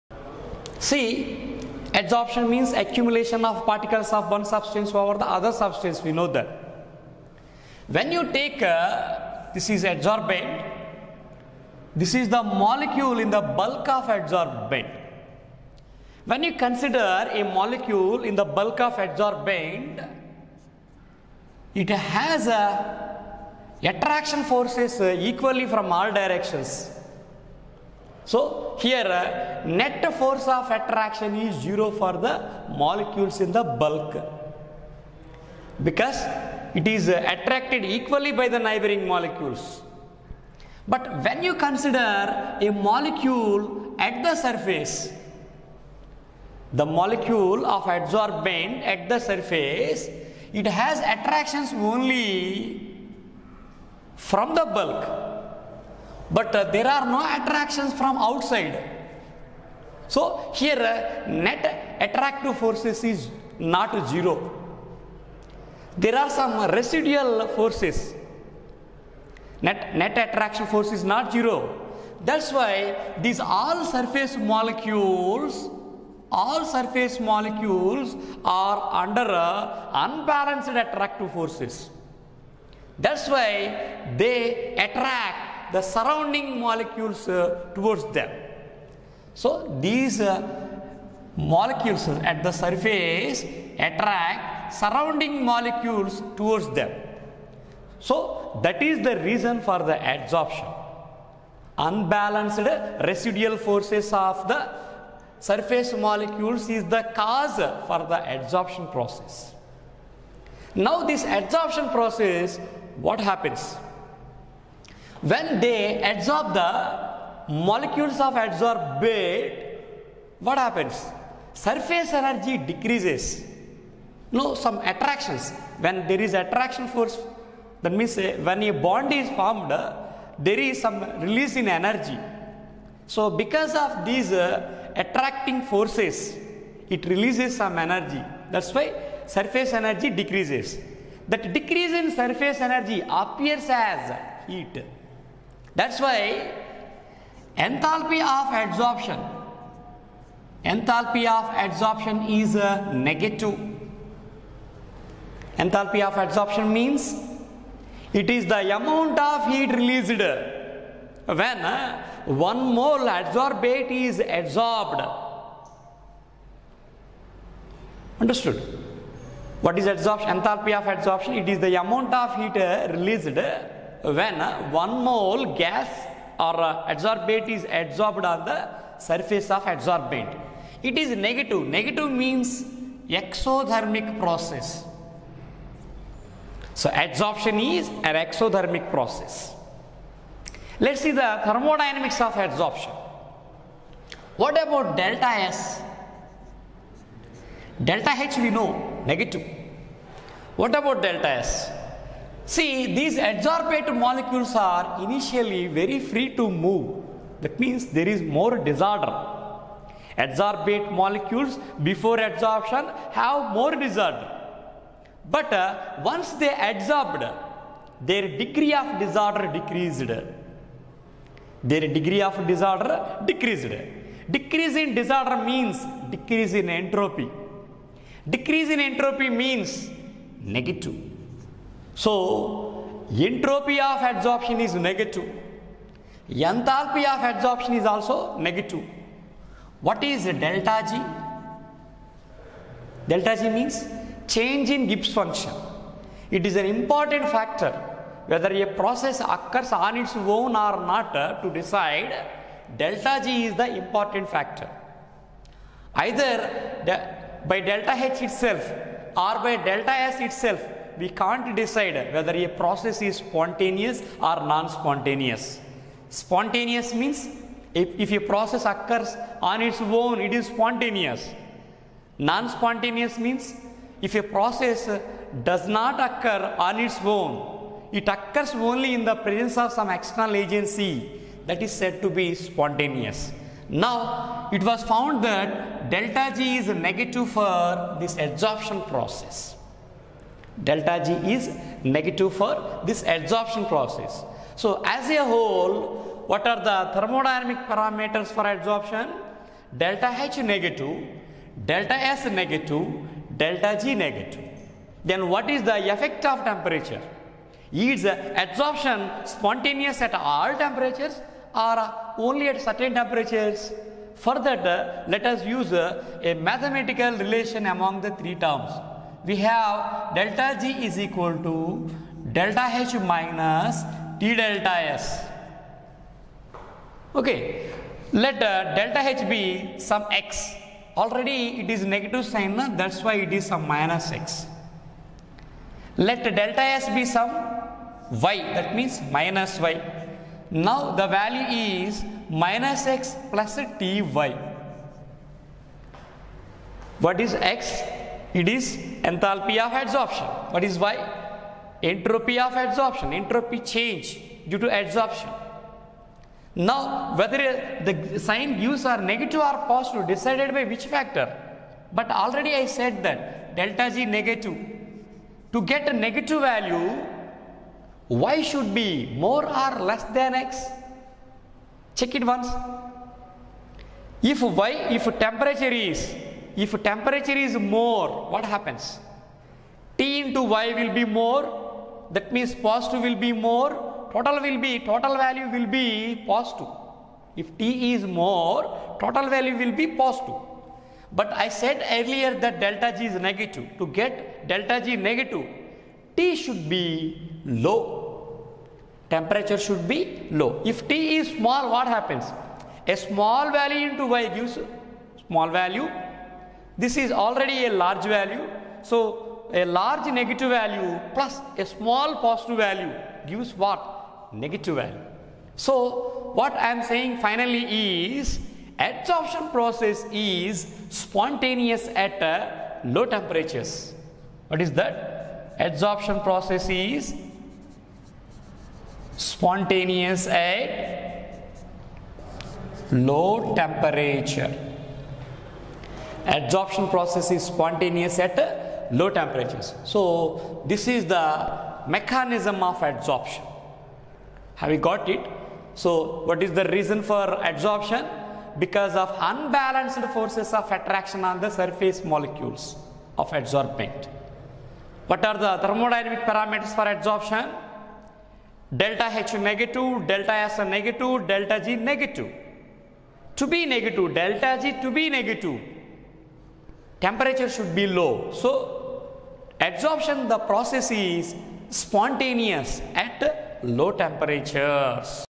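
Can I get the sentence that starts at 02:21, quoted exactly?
That decrease in surface energy appears as heat.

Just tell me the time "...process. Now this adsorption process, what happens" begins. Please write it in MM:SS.
01:48.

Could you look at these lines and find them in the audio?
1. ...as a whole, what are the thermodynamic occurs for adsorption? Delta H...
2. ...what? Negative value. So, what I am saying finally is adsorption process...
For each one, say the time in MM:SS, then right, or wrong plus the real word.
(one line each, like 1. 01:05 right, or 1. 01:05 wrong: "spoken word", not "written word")
1. 04:54 wrong: "parameters", not "occurs"
2. 06:53 right.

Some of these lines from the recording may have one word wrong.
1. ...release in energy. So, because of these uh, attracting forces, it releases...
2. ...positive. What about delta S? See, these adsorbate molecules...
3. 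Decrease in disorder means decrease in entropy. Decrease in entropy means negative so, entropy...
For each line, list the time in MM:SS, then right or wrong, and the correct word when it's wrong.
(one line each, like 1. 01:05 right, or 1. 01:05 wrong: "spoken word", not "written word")
1. 02:11 right
2. 03:19 wrong: "negative", not "positive"
3. 03:44 right.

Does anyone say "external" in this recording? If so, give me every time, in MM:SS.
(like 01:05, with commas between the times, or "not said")
04:39.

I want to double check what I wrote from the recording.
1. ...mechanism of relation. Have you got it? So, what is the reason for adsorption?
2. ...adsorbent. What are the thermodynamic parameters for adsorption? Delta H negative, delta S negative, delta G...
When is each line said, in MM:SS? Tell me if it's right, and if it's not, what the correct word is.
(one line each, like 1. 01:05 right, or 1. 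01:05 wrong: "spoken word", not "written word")
1. 07:21 wrong: "adsorption", not "relation"
2. 07:33 right.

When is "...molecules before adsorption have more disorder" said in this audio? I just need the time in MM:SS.
03:30.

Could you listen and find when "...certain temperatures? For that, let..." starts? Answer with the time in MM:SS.
05:12.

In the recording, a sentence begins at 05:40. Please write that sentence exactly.
Now the value is minus X plus Ty.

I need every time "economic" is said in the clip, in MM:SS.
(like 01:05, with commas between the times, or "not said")
not said.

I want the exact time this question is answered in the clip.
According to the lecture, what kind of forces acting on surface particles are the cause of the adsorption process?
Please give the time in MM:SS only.
01:41.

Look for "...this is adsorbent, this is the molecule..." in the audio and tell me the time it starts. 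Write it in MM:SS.
00:09.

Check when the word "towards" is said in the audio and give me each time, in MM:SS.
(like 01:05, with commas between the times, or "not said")
01:27, 01:36.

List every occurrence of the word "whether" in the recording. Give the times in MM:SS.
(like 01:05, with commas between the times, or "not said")
04:08, 04:22, 05:57.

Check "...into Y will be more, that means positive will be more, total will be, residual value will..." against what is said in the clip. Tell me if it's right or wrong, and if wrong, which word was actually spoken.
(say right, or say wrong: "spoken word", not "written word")
wrong: "total", not "residual".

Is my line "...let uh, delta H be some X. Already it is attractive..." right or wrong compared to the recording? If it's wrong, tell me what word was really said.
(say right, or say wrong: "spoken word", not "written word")
wrong: "negative", not "attractive".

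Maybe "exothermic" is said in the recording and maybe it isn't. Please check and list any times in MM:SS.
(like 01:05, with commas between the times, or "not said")
03:03, 03:08.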